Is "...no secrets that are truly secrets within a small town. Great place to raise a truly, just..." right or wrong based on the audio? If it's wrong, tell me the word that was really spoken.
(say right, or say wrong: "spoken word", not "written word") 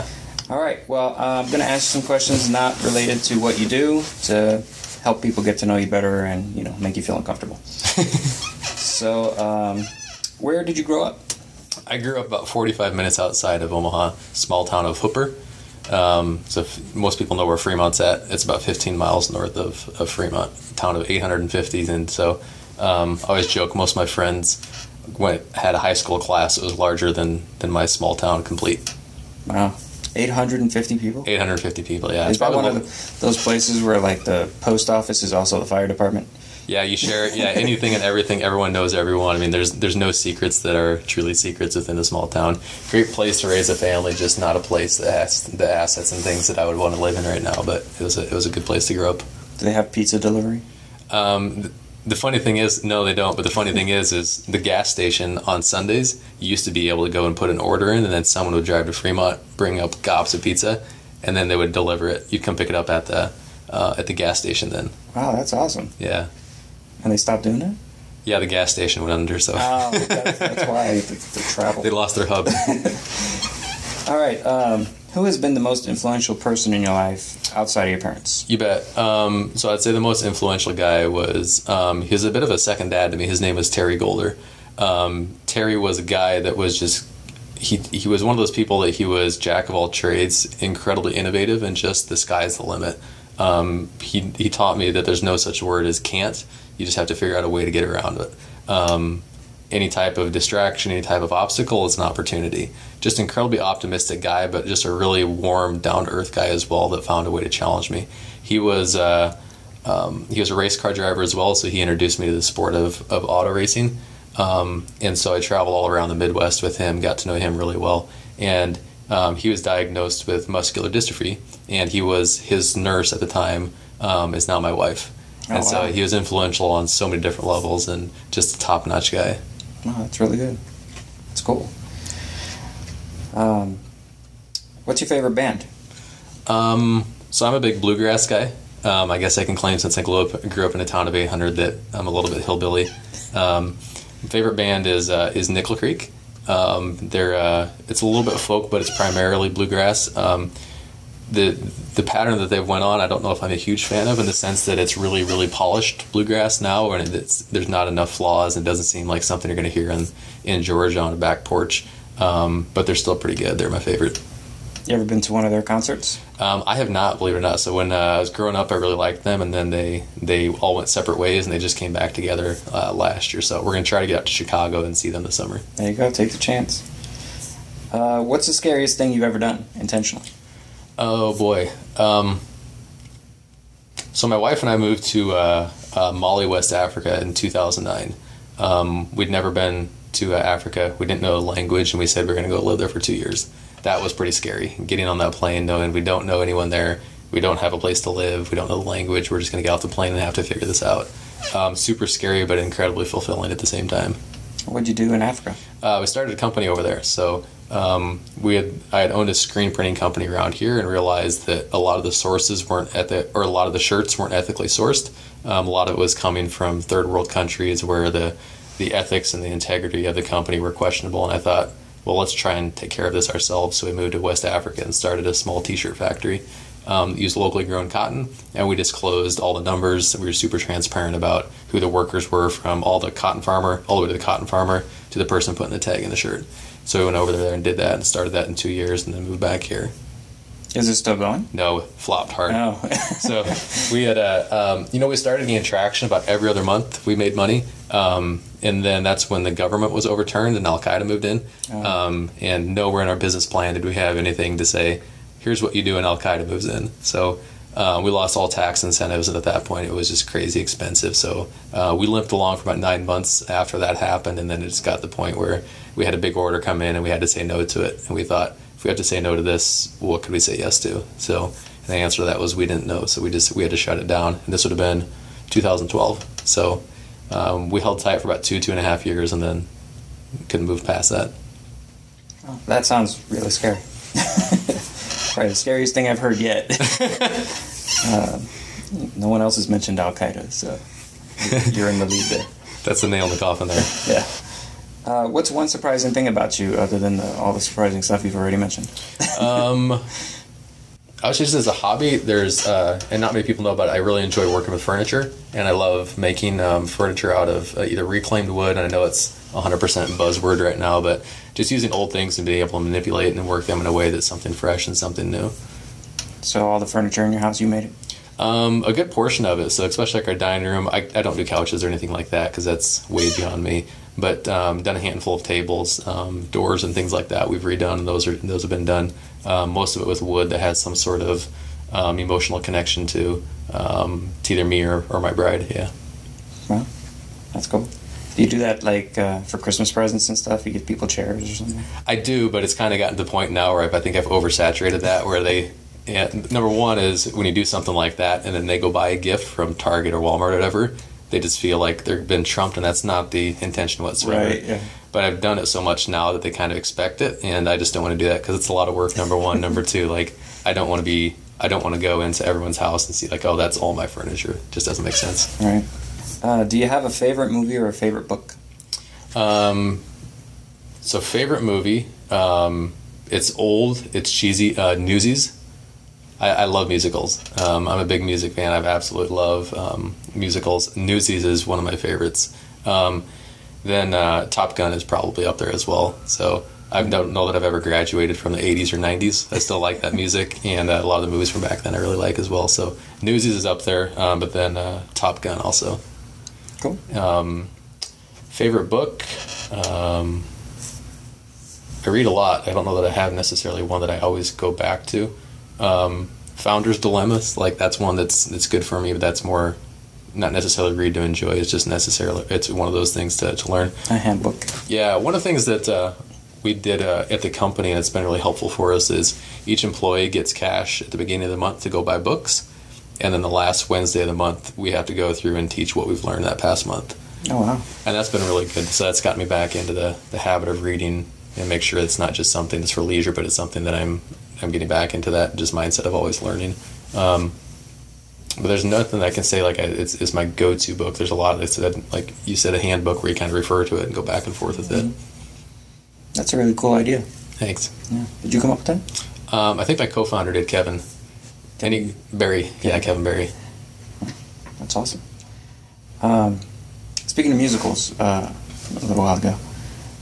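wrong: "family", not "truly".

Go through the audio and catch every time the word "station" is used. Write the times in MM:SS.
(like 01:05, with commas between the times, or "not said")
00:54, 01:04, 01:08.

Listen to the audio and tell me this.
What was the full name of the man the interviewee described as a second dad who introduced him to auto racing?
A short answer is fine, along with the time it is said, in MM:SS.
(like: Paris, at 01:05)
Terry Golder, at 01:23.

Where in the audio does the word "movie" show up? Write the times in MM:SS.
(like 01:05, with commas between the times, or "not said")
06:07, 06:11, 06:31.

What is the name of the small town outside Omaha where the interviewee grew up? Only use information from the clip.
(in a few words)
Hooper.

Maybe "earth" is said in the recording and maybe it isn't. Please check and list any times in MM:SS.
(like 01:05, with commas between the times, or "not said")
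01:46.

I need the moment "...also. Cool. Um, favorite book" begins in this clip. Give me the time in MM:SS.
06:35.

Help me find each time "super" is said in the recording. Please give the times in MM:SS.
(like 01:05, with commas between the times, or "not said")
03:21, 03:50.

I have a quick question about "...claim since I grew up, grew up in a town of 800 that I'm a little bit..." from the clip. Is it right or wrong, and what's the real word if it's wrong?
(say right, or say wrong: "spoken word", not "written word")
right.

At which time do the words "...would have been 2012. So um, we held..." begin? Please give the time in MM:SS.
04:34.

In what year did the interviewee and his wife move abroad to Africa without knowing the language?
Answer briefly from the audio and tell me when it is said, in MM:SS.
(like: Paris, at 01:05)
2009, at 03:07.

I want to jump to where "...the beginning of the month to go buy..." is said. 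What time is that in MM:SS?
07:01.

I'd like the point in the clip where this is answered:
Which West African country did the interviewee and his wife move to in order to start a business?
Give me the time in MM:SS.
03:06.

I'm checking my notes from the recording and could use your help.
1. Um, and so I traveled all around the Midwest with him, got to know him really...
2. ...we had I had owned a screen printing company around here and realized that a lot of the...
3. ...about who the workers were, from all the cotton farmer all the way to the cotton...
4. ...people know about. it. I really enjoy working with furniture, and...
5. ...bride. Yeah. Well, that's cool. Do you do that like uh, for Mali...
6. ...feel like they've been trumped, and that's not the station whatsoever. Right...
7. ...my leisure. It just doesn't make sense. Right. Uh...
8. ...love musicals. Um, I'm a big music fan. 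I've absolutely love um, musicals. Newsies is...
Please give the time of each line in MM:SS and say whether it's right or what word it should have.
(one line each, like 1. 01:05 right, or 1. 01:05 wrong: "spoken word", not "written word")
1. 01:54 right
2. 03:28 right
3. 03:51 right
4. 05:03 right
5. 05:35 wrong: "Christmas", not "Mali"
6. 05:51 wrong: "intention", not "station"
7. 06:03 wrong: "furniture", not "leisure"
8. 06:16 right.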